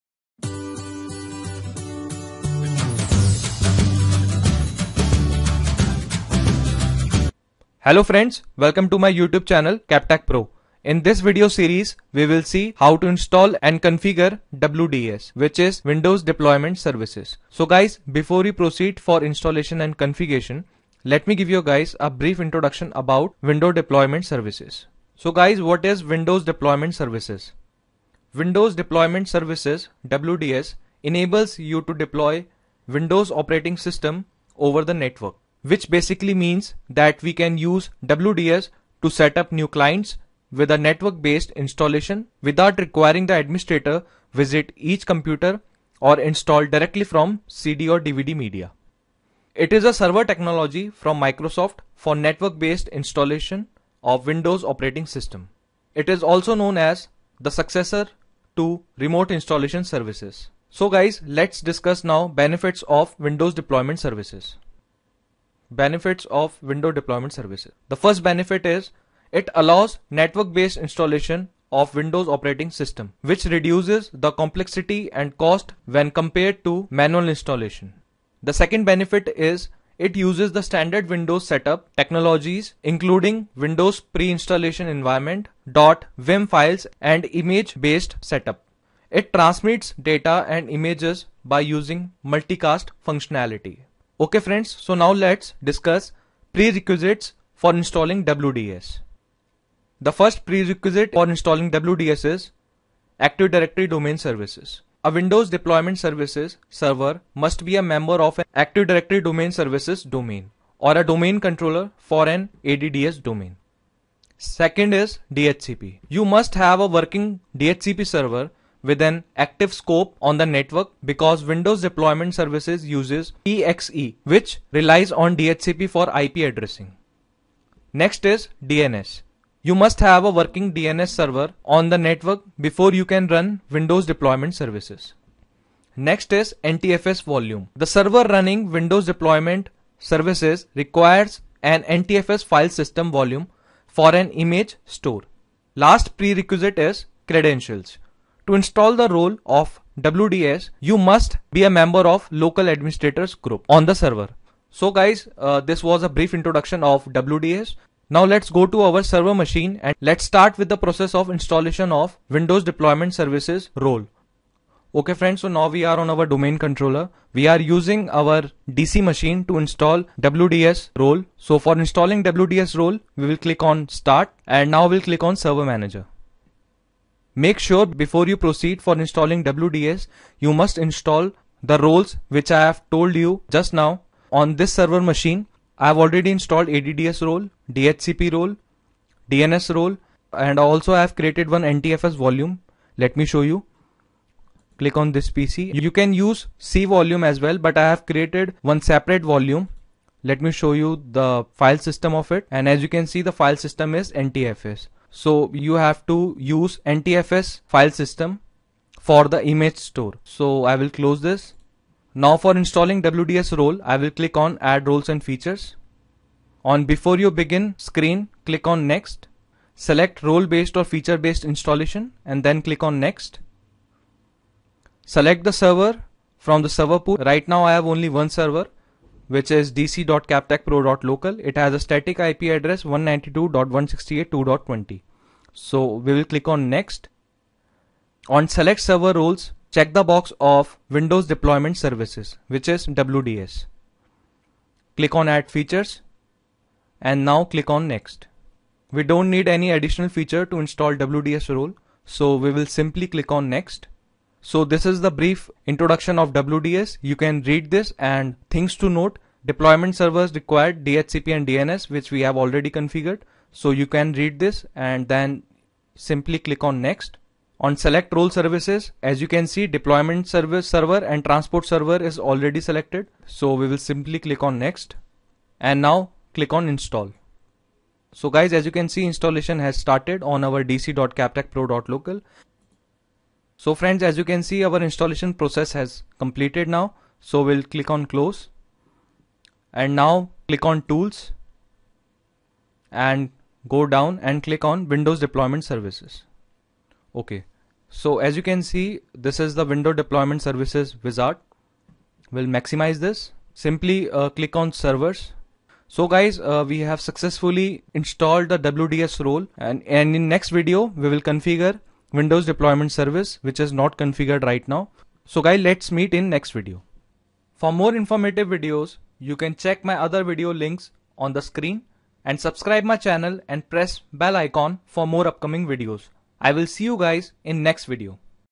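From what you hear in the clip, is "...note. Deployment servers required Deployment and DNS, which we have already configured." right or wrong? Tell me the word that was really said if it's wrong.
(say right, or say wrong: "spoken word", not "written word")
wrong: "DHCP", not "Deployment".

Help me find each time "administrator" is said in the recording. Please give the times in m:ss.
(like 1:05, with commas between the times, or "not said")
0:43, 2:32.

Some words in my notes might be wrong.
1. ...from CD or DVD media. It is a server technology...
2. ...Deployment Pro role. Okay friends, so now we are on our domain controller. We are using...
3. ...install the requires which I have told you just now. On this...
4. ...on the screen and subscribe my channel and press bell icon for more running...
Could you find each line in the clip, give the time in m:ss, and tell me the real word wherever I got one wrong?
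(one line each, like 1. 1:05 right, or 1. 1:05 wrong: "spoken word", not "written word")
1. 0:47 right
2. 2:42 wrong: "Services", not "Pro"
3. 3:00 wrong: "roles", not "requires"
4. 5:21 wrong: "upcoming", not "running".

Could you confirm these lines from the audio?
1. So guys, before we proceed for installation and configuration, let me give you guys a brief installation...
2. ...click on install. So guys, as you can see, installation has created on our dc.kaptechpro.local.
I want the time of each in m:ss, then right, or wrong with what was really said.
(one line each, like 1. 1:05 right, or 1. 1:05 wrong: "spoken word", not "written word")
1. 0:17 wrong: "introduction", not "installation"
2. 4:36 wrong: "started", not "created".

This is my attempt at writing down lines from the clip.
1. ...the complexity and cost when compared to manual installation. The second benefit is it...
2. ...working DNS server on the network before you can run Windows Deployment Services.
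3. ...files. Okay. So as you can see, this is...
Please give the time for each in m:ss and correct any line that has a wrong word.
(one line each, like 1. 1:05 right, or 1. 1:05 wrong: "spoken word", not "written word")
1. 1:14 right
2. 2:10 right
3. 4:55 wrong: "services", not "files".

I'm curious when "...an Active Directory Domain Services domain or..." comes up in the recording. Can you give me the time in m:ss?
1:48.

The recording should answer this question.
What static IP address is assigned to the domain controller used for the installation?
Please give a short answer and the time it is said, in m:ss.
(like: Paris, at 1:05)
192.168.2.20, at 3:52.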